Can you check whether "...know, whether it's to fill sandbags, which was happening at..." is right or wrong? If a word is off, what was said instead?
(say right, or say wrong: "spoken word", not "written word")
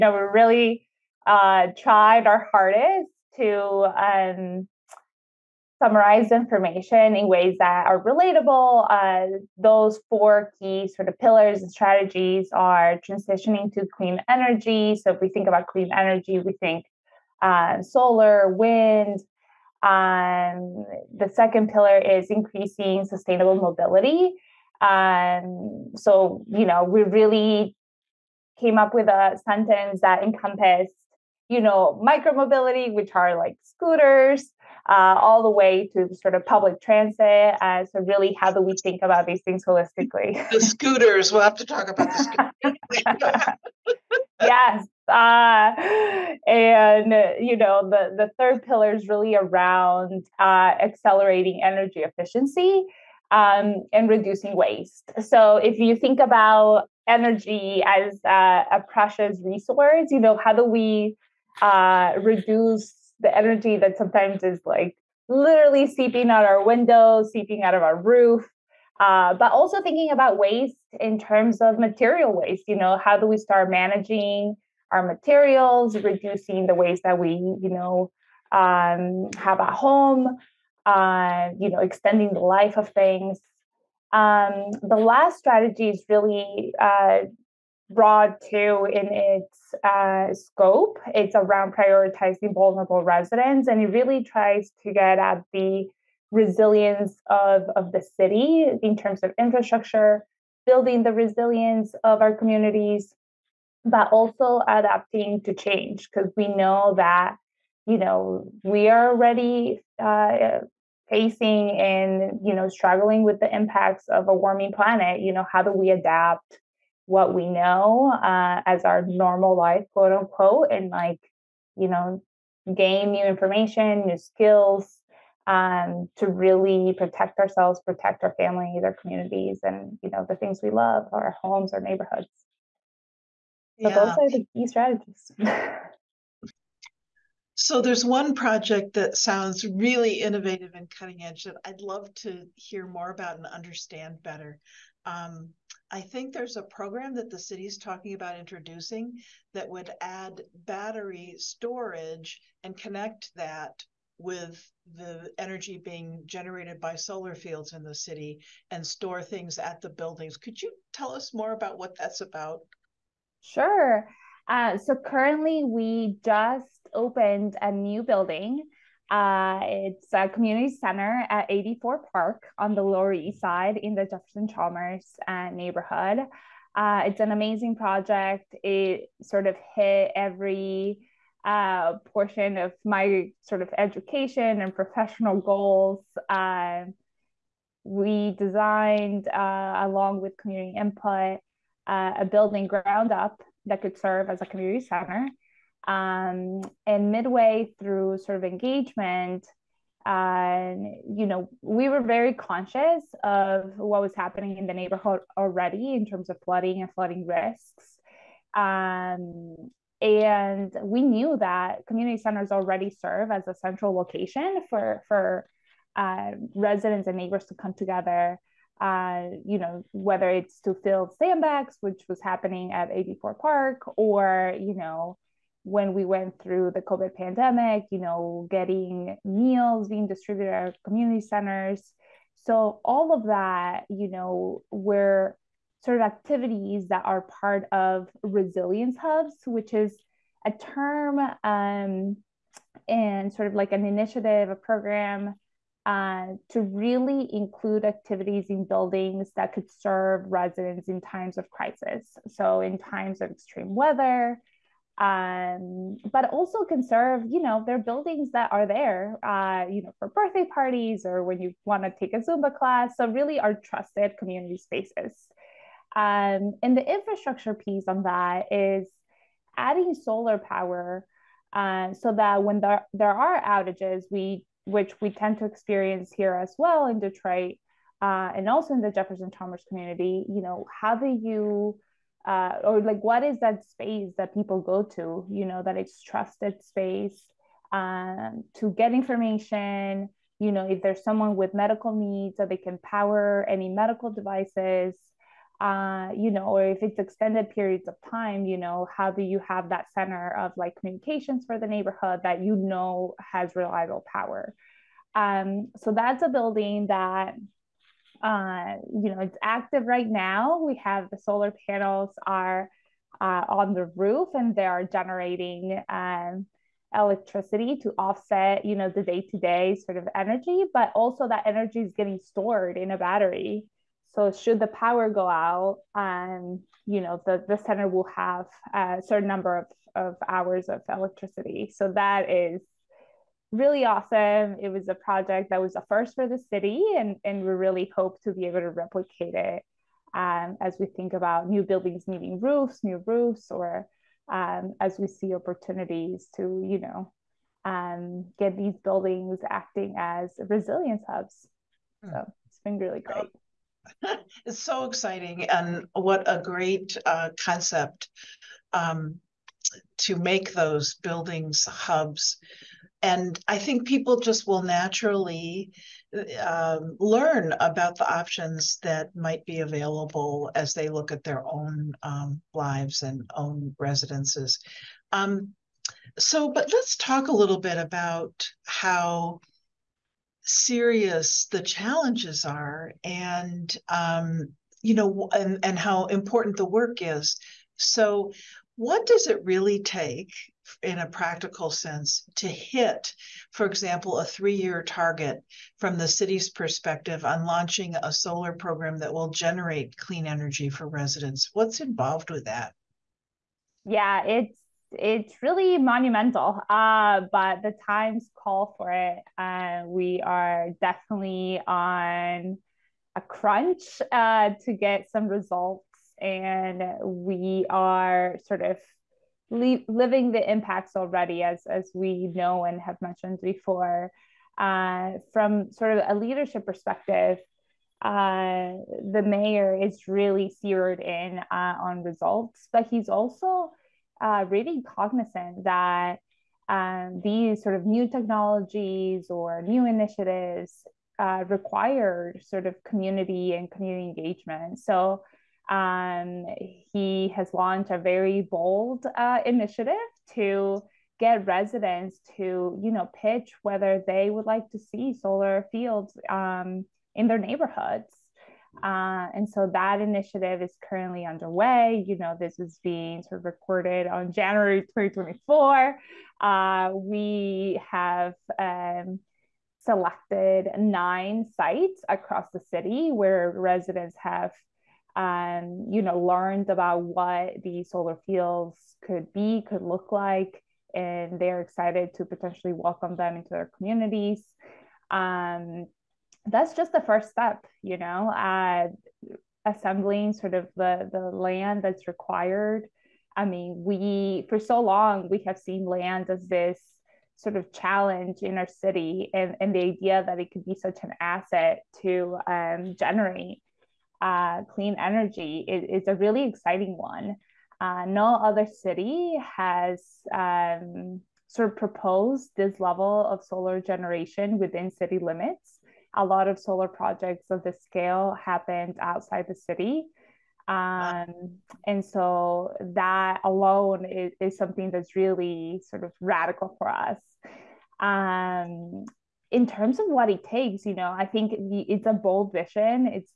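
right.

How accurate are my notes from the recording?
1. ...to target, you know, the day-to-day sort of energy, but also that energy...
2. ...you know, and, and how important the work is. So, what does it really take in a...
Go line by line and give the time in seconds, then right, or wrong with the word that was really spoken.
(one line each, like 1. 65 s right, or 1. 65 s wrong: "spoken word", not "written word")
1. 317 s wrong: "offset", not "target"
2. 384 s right.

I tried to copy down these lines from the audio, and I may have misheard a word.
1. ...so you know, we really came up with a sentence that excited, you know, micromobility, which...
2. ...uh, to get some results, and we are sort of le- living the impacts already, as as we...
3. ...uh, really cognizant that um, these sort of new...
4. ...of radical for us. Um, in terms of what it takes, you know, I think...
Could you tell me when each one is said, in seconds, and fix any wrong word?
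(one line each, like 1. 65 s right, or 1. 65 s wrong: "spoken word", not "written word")
1. 25 s wrong: "encompassed", not "excited"
2. 414 s right
3. 434 s right
4. 526 s right.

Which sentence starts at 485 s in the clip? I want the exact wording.
Um, that's just the first step, you know, uh, assembling sort of the, the land that's required.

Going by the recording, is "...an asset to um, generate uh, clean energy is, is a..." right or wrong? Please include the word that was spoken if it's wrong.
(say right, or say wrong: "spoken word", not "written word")
right.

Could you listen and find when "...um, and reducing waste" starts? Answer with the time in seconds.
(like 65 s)
53 s.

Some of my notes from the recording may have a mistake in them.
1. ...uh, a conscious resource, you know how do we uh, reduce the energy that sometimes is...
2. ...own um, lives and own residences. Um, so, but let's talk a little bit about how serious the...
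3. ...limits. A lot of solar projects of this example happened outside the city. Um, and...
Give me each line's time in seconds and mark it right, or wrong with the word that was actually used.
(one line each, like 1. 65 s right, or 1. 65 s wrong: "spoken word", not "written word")
1. 58 s wrong: "precious", not "conscious"
2. 371 s right
3. 515 s wrong: "scale", not "example".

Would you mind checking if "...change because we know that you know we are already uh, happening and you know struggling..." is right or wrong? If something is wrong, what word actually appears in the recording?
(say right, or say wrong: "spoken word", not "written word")
wrong: "facing", not "happening".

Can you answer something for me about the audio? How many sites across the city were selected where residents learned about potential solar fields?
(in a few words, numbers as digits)
9.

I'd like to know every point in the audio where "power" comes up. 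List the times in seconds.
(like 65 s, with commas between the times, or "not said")
270 s, 292 s, 304 s, 324 s.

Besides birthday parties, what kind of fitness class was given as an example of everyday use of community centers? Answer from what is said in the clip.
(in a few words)
Zumba.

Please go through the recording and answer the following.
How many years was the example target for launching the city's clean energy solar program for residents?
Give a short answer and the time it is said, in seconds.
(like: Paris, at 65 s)
3, at 394 s.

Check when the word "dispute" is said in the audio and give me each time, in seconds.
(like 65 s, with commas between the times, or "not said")
not said.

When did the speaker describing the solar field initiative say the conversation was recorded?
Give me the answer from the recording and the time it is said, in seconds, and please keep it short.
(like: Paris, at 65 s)
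January 2024, at 464 s.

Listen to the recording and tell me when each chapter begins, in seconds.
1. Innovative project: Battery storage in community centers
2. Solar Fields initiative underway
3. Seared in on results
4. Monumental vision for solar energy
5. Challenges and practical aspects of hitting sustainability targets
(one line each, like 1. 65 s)
1. 138 s
2. 465 s
3. 430 s
4. 516 s
5. 396 s.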